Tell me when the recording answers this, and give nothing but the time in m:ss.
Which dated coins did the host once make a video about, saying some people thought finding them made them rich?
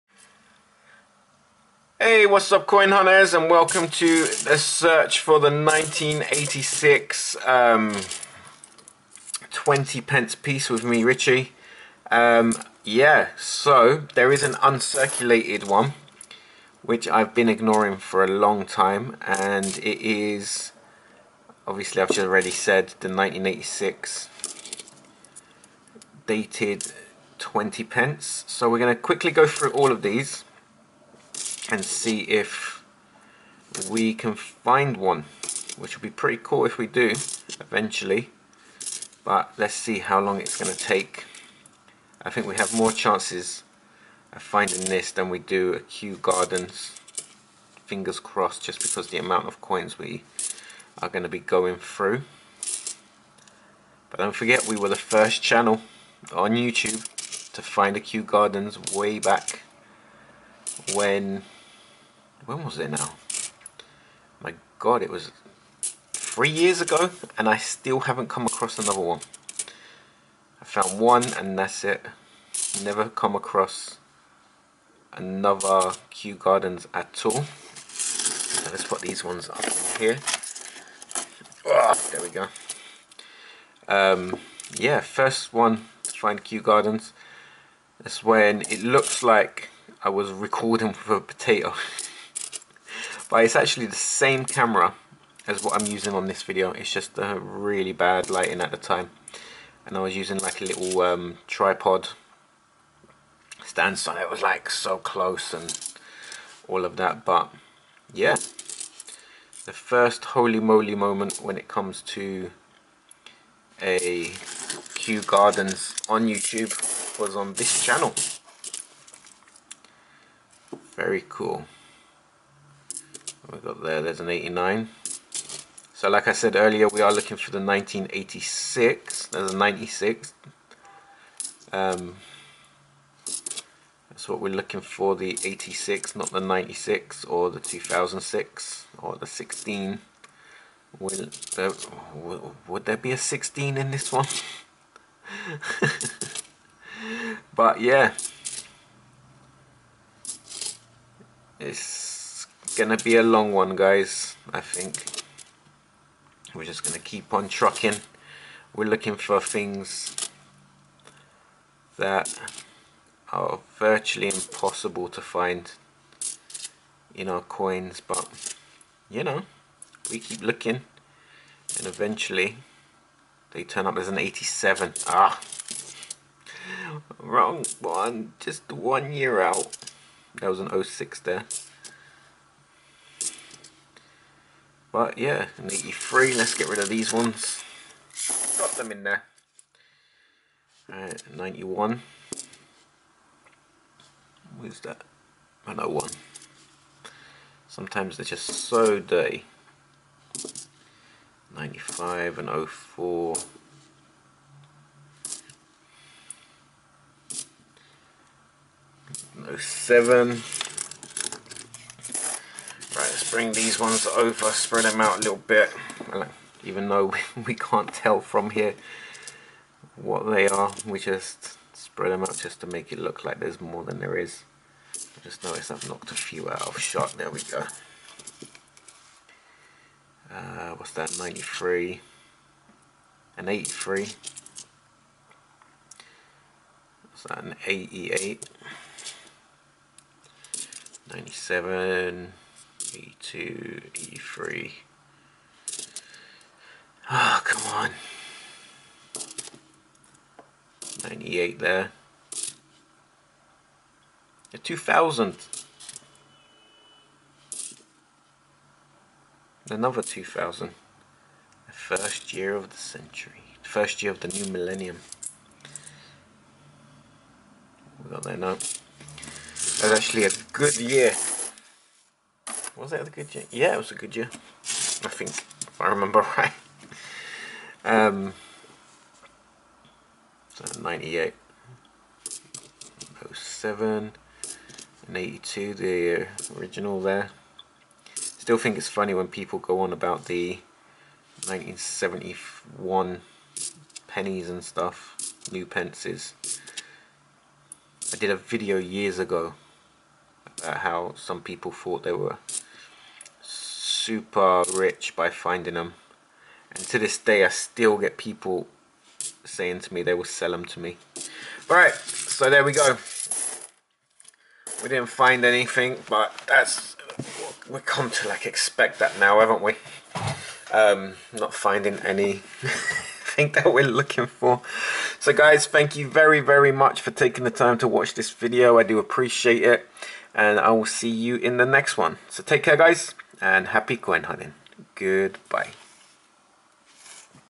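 4:51.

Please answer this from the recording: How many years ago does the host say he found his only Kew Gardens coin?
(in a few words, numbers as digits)
3 years.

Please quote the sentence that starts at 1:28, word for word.
That's when it looks like I was recording for a potato.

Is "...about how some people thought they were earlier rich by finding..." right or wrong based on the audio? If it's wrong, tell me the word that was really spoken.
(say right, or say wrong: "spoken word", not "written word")
wrong: "super", not "earlier".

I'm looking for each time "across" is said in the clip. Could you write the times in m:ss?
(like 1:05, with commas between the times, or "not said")
1:08, 1:13.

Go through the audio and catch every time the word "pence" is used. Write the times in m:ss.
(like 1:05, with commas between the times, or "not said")
0:10, 0:27, 4:55.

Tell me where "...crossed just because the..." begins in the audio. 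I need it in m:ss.
0:48.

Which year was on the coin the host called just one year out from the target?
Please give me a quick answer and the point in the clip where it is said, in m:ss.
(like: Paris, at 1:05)
1987, at 2:54.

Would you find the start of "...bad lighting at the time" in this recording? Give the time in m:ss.
1:37.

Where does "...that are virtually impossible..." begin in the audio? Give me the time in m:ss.
2:41.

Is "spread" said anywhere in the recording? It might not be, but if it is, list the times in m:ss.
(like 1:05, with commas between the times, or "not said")
3:34, 3:41.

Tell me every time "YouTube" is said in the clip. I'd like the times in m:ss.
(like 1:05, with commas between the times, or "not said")
0:56, 1:56.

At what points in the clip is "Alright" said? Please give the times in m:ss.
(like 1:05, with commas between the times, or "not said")
3:10, 5:11.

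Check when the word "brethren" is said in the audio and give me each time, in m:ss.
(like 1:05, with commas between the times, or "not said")
not said.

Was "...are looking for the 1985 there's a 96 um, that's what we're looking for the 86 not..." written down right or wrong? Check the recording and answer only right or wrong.
wrong.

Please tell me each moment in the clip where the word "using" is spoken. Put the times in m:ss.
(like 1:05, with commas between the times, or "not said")
1:35, 1:40.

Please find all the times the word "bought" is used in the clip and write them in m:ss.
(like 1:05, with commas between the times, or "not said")
not said.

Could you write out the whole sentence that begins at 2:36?
We're just gonna keep on trucking.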